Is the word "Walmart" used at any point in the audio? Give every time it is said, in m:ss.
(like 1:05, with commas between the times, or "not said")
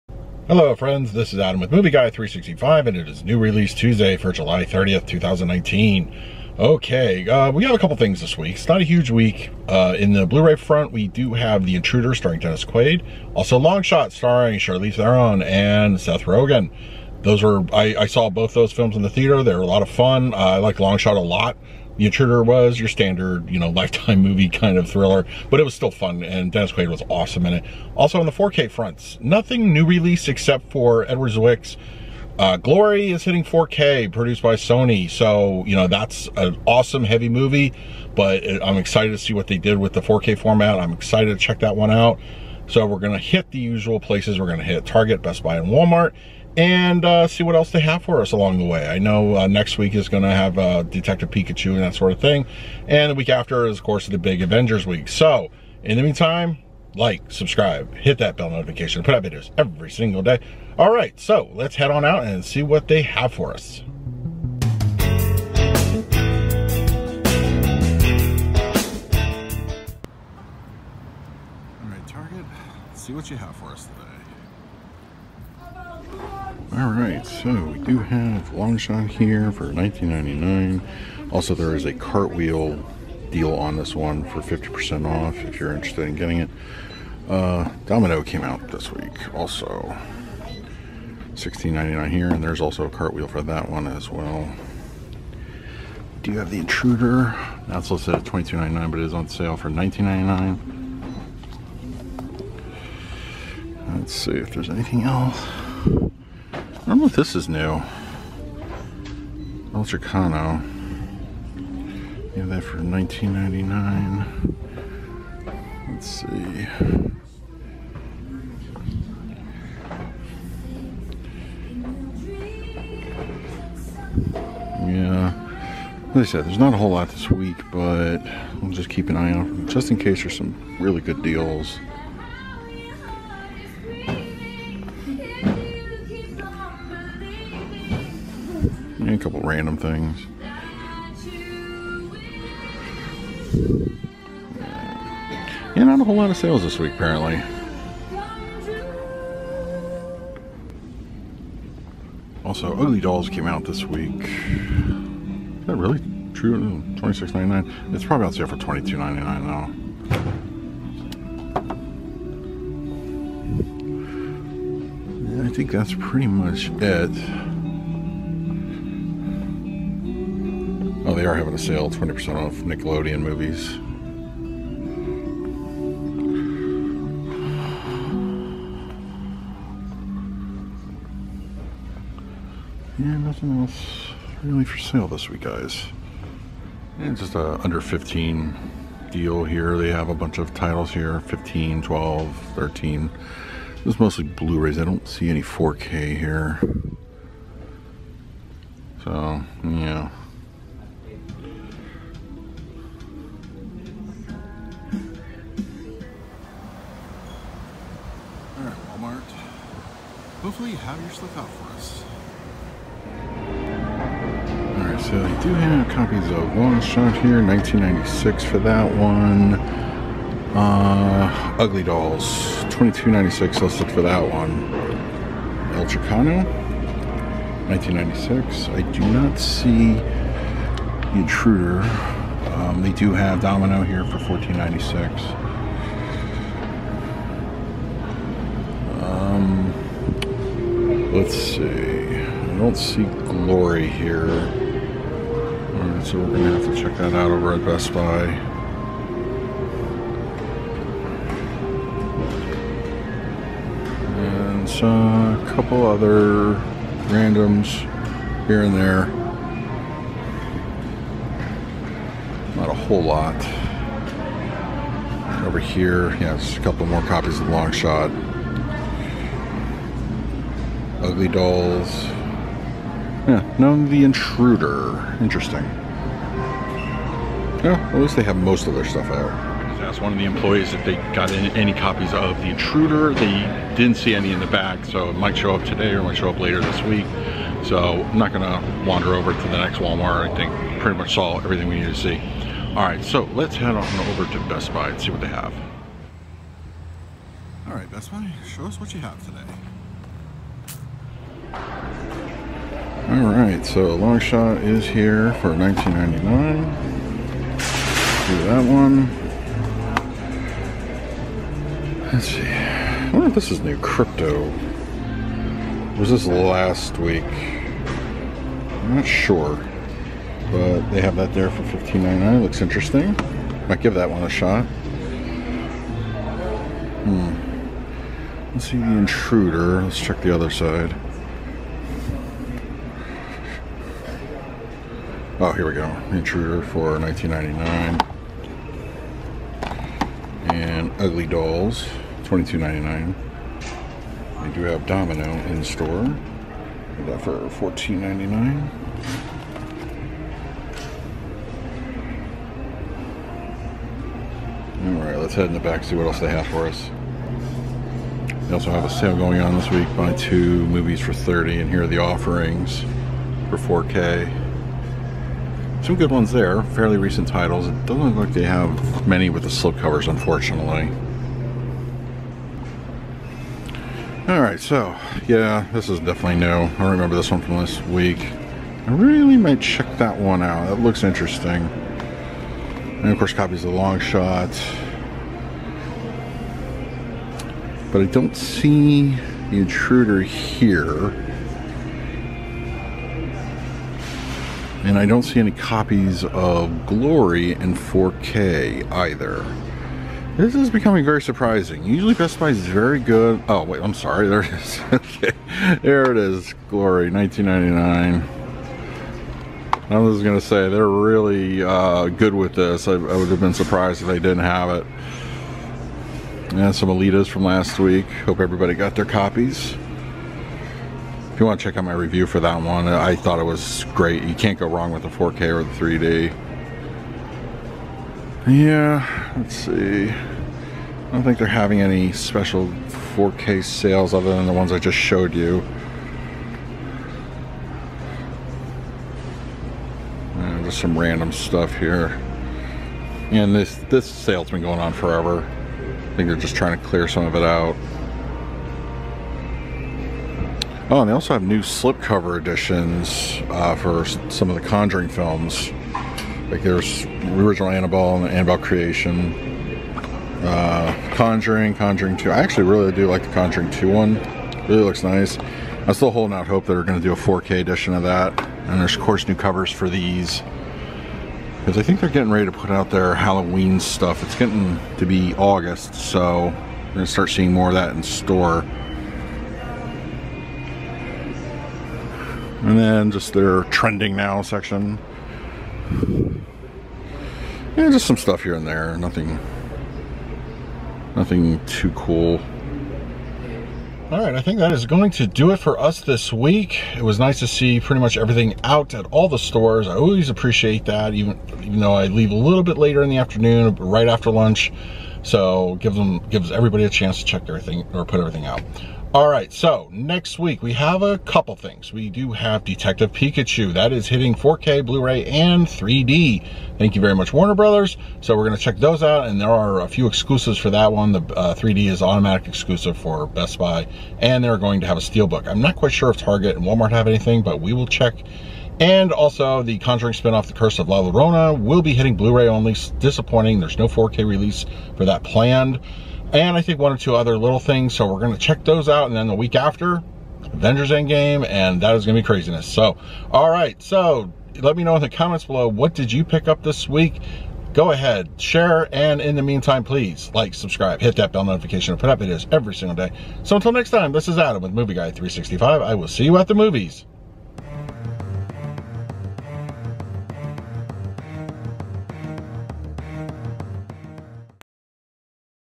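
0:45, 4:49, 8:46.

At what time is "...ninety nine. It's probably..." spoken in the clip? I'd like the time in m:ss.
2:37.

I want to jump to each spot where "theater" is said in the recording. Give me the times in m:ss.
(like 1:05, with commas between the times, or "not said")
0:19.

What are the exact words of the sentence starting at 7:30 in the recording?
Oh, and they also have new slipcover editions uh, for some of the Conjuring films.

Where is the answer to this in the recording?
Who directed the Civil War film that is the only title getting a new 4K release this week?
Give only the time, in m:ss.
0:31.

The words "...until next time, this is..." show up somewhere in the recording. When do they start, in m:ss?
9:13.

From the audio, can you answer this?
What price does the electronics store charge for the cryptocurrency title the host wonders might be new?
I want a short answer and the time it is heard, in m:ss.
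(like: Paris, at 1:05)
$15.99, at 5:21.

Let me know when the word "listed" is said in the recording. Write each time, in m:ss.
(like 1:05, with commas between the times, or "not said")
1:37, 3:43.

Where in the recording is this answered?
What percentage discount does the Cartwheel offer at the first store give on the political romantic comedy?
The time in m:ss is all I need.
1:24.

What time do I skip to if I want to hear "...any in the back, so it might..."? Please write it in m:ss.
4:44.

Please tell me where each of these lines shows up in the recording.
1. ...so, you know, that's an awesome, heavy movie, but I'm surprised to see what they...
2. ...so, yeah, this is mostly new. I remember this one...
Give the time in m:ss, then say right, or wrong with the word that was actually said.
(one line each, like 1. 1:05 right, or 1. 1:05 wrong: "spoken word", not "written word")
1. 0:35 wrong: "excited", not "surprised"
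2. 6:14 wrong: "definitely", not "mostly".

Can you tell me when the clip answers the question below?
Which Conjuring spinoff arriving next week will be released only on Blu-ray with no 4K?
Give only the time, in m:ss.
8:50.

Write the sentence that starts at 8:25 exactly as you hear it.
So gives them gives everybody a chance to check everything or put everything out.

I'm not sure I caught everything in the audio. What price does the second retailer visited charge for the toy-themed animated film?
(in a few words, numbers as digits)
$22.96.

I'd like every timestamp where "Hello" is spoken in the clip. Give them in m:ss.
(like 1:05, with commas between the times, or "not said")
0:00.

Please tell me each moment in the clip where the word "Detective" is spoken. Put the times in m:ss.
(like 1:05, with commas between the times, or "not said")
0:50, 8:32.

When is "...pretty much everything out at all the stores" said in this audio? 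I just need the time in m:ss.
8:17.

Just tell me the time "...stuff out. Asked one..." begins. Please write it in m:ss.
4:38.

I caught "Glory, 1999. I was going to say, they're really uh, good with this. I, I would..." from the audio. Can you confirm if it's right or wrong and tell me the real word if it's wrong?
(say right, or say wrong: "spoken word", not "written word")
right.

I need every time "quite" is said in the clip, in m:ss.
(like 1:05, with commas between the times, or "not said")
8:45.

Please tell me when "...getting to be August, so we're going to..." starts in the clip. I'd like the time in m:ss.
7:54.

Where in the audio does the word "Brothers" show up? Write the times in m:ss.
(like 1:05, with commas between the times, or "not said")
8:37.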